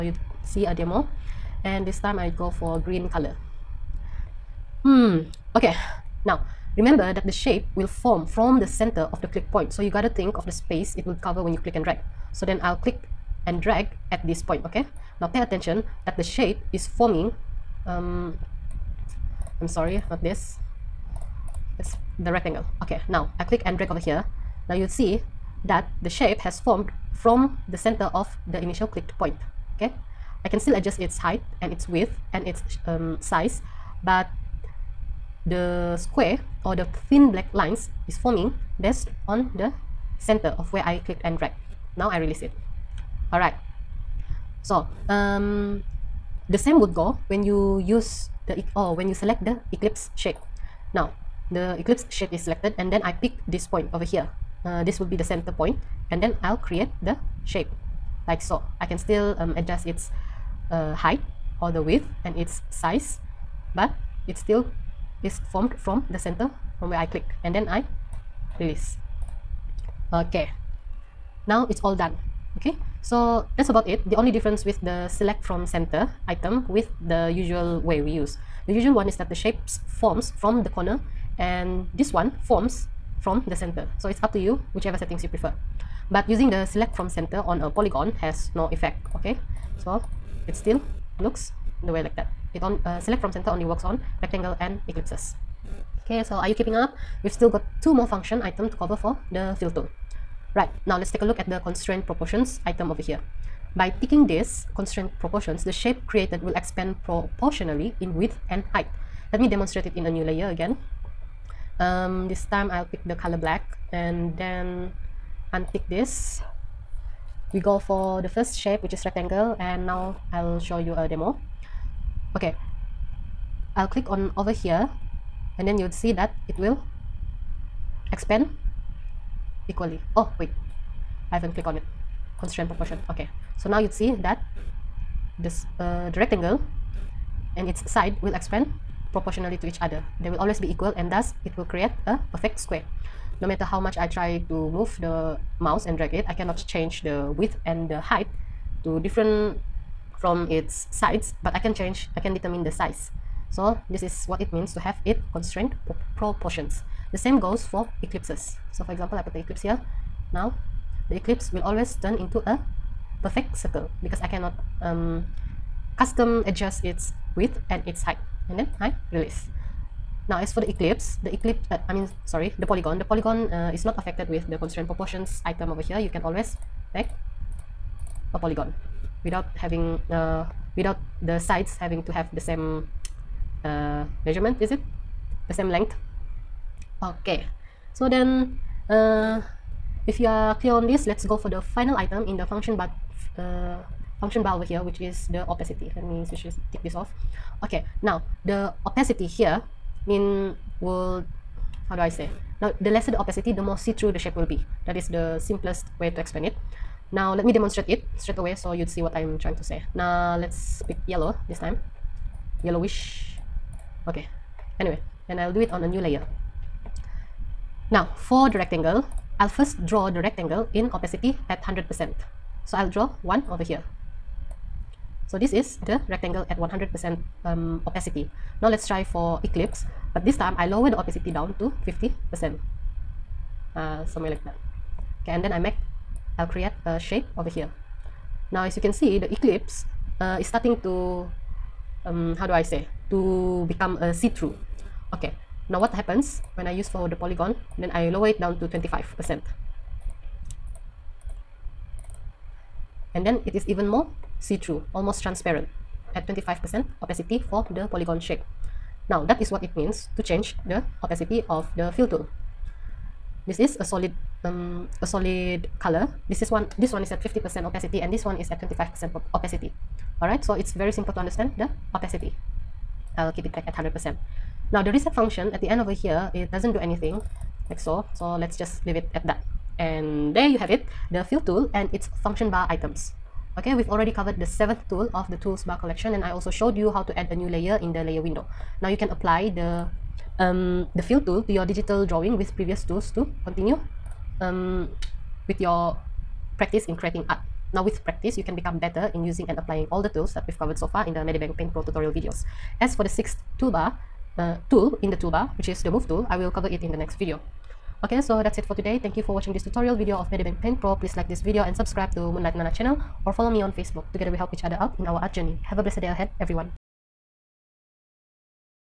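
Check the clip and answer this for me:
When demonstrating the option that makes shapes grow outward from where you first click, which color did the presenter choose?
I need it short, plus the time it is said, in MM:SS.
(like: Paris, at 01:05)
Green, at 00:02.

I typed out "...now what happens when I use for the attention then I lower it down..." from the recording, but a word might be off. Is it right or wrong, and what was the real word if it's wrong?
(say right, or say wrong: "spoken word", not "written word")
wrong: "polygon", not "attention".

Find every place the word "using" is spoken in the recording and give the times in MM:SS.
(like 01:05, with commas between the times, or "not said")
01:26, 04:59.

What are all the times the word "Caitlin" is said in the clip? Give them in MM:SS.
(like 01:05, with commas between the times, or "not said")
not said.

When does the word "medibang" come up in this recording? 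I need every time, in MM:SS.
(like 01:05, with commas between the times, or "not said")
05:01, 05:10.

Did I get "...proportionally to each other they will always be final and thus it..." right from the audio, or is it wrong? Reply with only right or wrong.
wrong.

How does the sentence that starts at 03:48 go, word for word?
Now let's try for eclipse, but this time I lower the opacity down to 50%.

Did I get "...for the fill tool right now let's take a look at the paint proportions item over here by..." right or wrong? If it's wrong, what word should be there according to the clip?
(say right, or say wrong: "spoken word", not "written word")
wrong: "constraint", not "paint".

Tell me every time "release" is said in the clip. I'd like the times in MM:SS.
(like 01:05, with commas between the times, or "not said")
00:42, 01:08, 02:49.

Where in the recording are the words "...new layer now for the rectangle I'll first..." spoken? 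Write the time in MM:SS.
03:35.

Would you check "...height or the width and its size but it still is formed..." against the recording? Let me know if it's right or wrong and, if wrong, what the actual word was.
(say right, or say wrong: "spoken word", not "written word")
right.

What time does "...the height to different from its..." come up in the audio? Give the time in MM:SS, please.
02:27.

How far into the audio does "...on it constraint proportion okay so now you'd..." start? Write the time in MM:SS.
02:11.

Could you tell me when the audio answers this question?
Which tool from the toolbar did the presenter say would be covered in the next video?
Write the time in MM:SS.
05:05.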